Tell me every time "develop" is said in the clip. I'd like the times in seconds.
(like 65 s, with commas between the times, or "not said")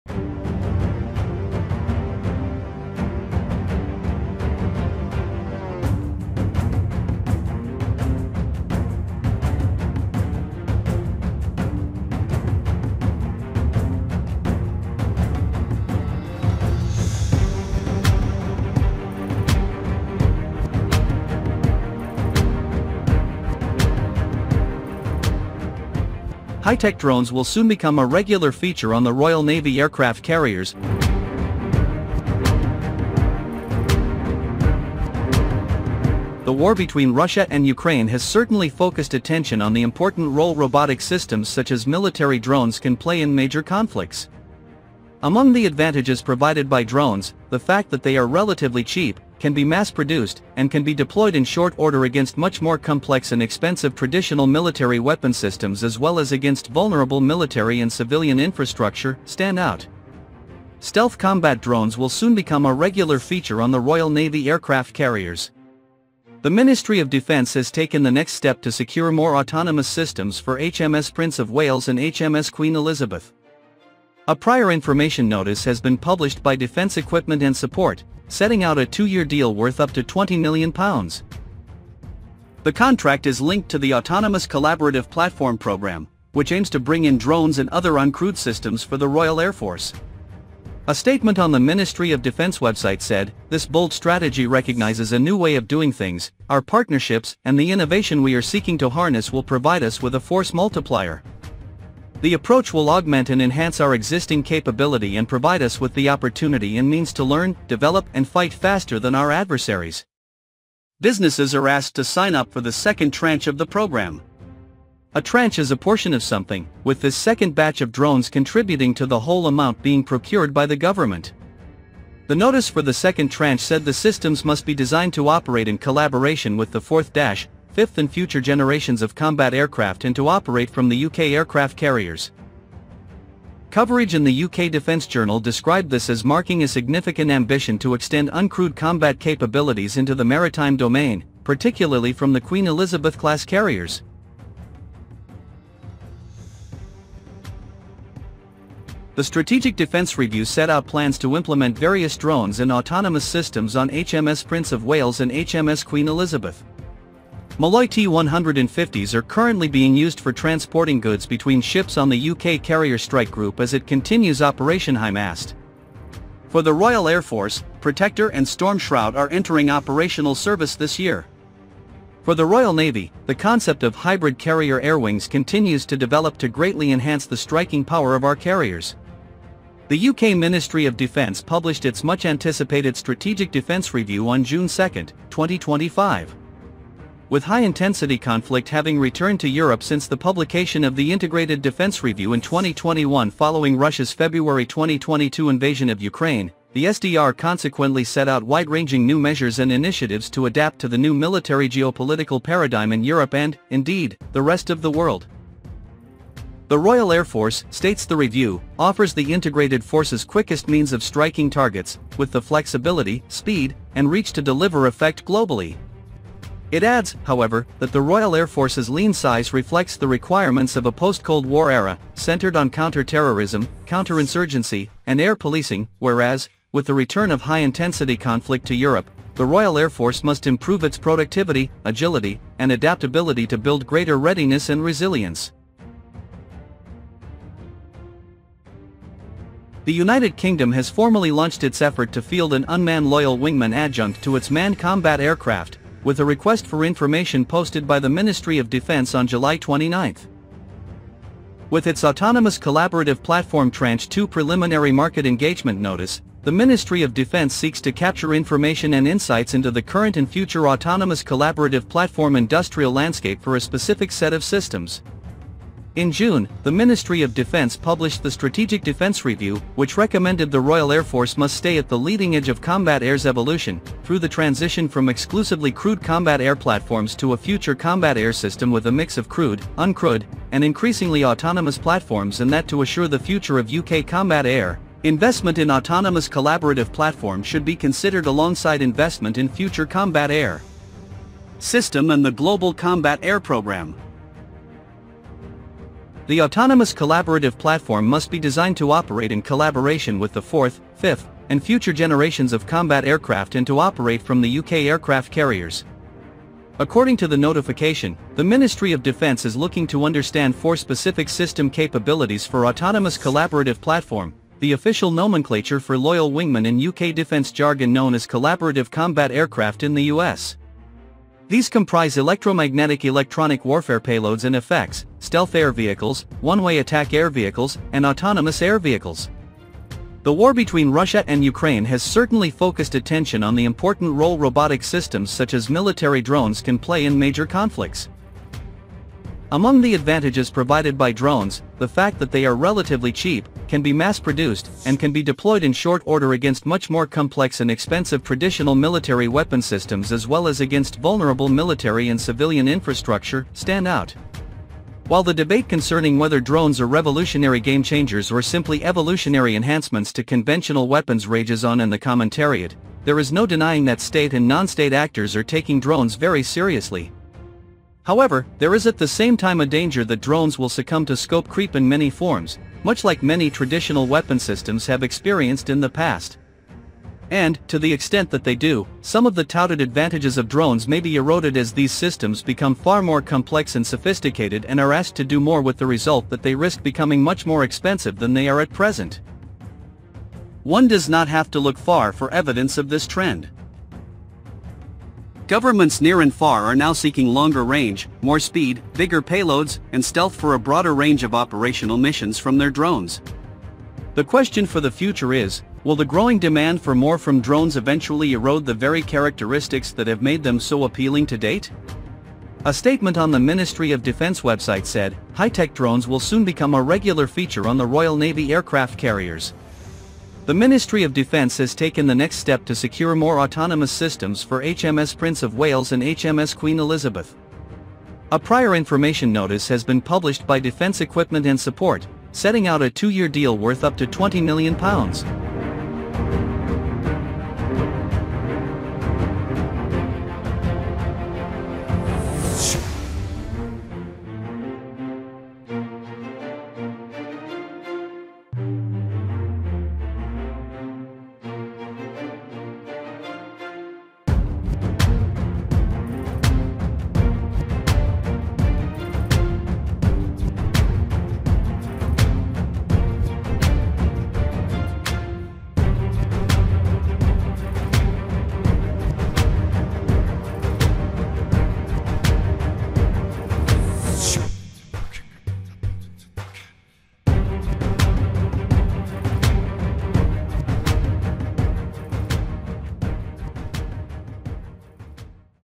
107 s, 175 s.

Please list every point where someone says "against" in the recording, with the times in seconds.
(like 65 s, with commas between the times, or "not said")
52 s, 56 s, 346 s, 350 s.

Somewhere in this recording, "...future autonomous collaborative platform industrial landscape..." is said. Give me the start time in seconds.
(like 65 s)
260 s.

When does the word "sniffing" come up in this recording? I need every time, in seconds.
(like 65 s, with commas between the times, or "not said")
not said.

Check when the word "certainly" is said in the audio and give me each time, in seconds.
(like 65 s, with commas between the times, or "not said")
38 s, 332 s.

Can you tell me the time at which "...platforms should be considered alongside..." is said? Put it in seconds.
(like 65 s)
286 s.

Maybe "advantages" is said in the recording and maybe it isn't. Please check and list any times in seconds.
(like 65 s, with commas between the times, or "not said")
45 s, 339 s, 379 s.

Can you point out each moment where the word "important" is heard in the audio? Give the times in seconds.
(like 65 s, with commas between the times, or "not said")
39 s, 333 s.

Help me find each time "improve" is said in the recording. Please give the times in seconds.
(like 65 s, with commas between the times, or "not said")
230 s.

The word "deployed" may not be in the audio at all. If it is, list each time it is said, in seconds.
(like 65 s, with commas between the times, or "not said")
50 s, 345 s.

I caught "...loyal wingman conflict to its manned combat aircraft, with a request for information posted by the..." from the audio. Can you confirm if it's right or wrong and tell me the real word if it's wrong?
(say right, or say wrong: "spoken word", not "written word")
wrong: "adjunct", not "conflict".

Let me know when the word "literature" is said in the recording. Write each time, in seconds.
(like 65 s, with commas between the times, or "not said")
not said.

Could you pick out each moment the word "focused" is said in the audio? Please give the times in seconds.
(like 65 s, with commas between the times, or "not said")
38 s, 332 s.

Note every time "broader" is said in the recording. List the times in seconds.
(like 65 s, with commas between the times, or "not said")
400 s.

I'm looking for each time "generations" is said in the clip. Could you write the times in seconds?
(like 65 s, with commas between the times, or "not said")
128 s, 301 s.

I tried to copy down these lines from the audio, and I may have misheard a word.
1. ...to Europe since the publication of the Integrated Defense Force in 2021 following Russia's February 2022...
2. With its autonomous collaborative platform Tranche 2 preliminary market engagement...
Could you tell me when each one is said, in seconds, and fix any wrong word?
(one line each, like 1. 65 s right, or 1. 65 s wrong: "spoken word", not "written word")
1. 189 s wrong: "Review", not "Force"
2. 251 s right.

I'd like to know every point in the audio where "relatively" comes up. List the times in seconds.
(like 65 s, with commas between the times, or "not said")
48 s, 342 s.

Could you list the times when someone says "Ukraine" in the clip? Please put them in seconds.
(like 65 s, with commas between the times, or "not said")
37 s, 196 s, 331 s.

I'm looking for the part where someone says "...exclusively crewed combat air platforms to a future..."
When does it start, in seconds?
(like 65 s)
275 s.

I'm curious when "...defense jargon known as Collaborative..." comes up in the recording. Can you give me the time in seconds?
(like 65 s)
317 s.